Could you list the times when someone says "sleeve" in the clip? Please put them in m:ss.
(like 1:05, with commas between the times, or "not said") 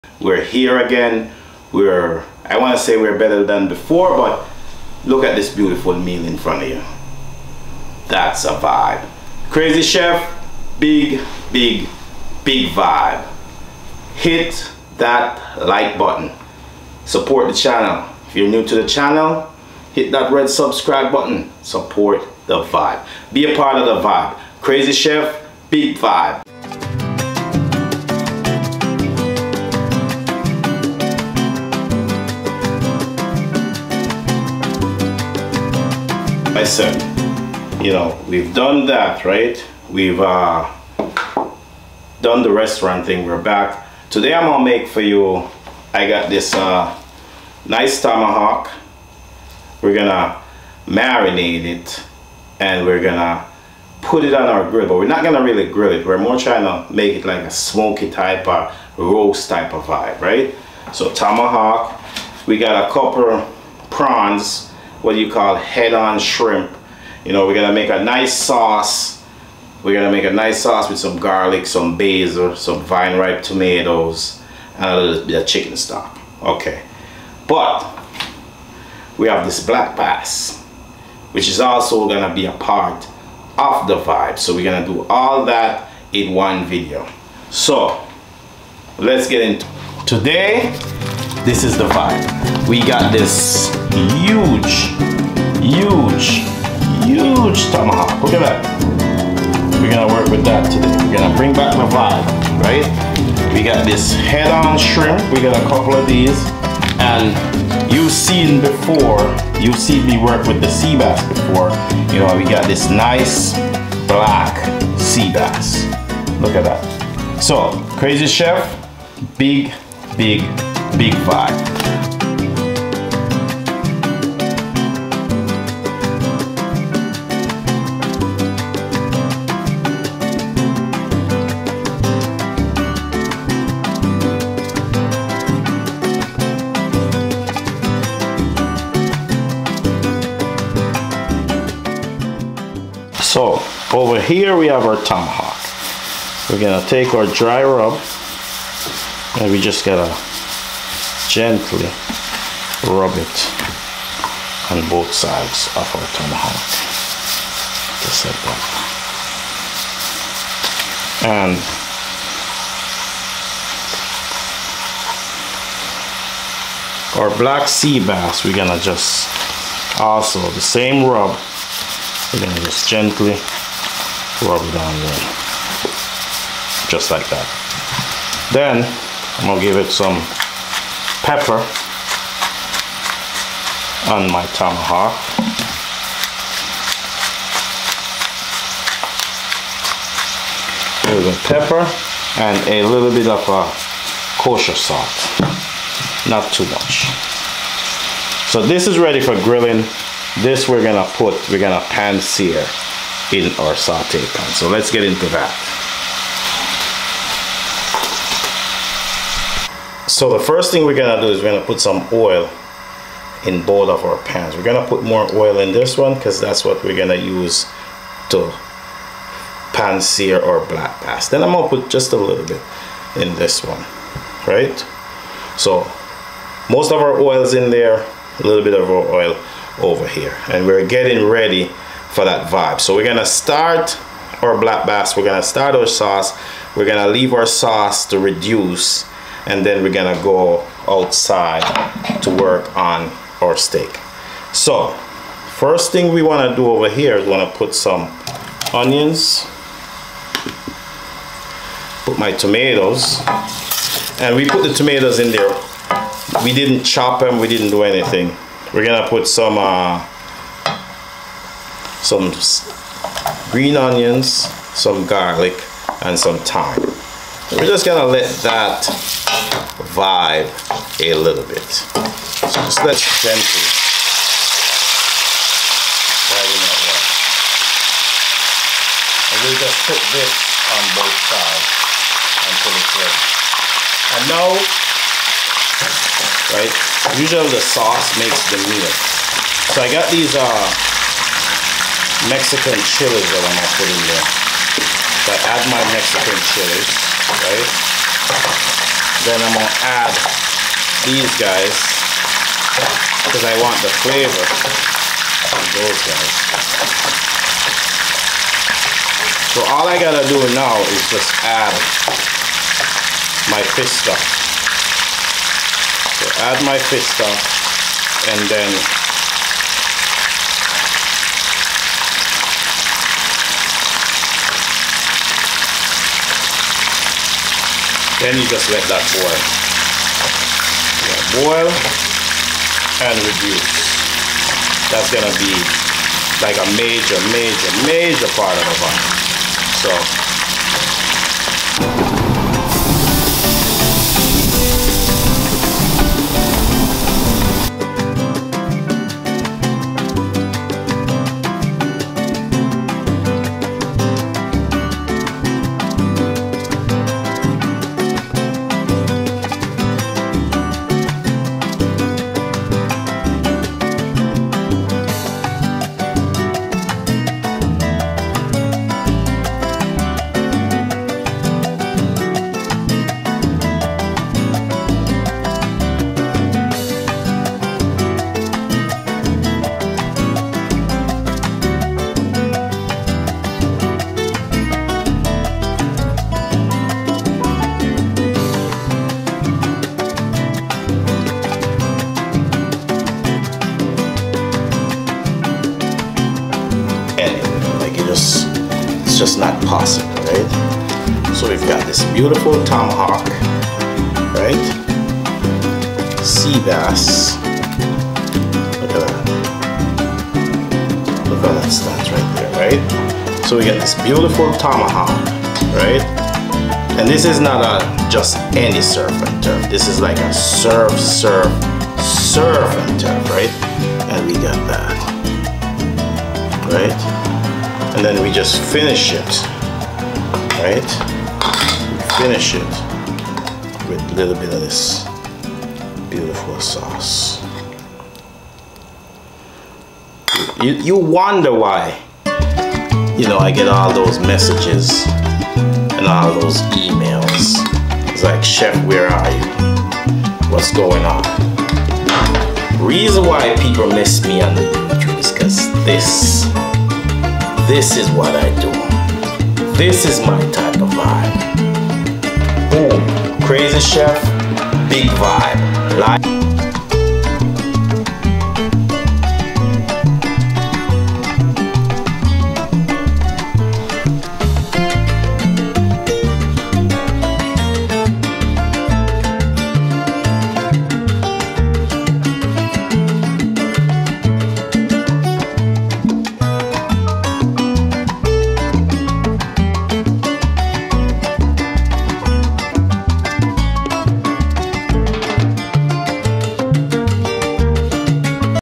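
not said.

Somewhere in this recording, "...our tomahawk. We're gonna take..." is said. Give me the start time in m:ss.
2:24.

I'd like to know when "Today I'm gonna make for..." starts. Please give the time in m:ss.
0:44.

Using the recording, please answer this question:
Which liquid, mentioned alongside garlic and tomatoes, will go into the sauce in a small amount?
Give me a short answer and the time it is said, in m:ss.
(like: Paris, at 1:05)
Chicken stock, at 1:15.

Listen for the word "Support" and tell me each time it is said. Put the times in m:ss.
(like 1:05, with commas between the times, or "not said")
0:17, 0:21.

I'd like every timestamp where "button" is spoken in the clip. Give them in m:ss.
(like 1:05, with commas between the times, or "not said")
0:15, 0:21.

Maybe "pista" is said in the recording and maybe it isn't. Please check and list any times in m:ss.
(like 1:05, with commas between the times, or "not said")
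5:16.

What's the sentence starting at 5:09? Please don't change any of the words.
So all I gotta do now is just add my fish stuff.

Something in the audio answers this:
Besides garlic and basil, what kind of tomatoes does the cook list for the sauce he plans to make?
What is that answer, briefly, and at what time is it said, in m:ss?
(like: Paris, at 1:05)
Vine ripe tomatoes, at 1:12.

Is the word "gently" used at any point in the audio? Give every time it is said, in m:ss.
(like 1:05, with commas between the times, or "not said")
2:31, 2:52, 4:33.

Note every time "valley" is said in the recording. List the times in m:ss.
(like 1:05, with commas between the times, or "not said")
not said.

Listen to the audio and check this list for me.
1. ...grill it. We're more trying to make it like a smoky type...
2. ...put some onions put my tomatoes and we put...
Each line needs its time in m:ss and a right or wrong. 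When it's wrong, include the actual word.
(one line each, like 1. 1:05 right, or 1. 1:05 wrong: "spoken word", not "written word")
1. 0:55 right
2. 4:07 right.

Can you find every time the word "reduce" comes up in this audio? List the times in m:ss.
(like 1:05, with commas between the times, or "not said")
3:58, 5:33.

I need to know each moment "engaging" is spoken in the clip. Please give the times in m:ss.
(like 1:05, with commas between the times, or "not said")
not said.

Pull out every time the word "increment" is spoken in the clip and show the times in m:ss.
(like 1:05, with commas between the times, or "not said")
not said.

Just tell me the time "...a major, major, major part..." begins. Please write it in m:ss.
5:36.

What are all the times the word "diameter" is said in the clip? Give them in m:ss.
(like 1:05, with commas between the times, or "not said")
not said.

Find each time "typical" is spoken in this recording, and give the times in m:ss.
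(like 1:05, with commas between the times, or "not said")
not said.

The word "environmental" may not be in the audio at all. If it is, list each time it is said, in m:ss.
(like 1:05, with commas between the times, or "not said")
not said.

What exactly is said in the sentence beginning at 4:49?
So I got these uh, Mexican chilies that I'm gonna put in there.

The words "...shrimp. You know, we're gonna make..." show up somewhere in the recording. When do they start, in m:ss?
1:06.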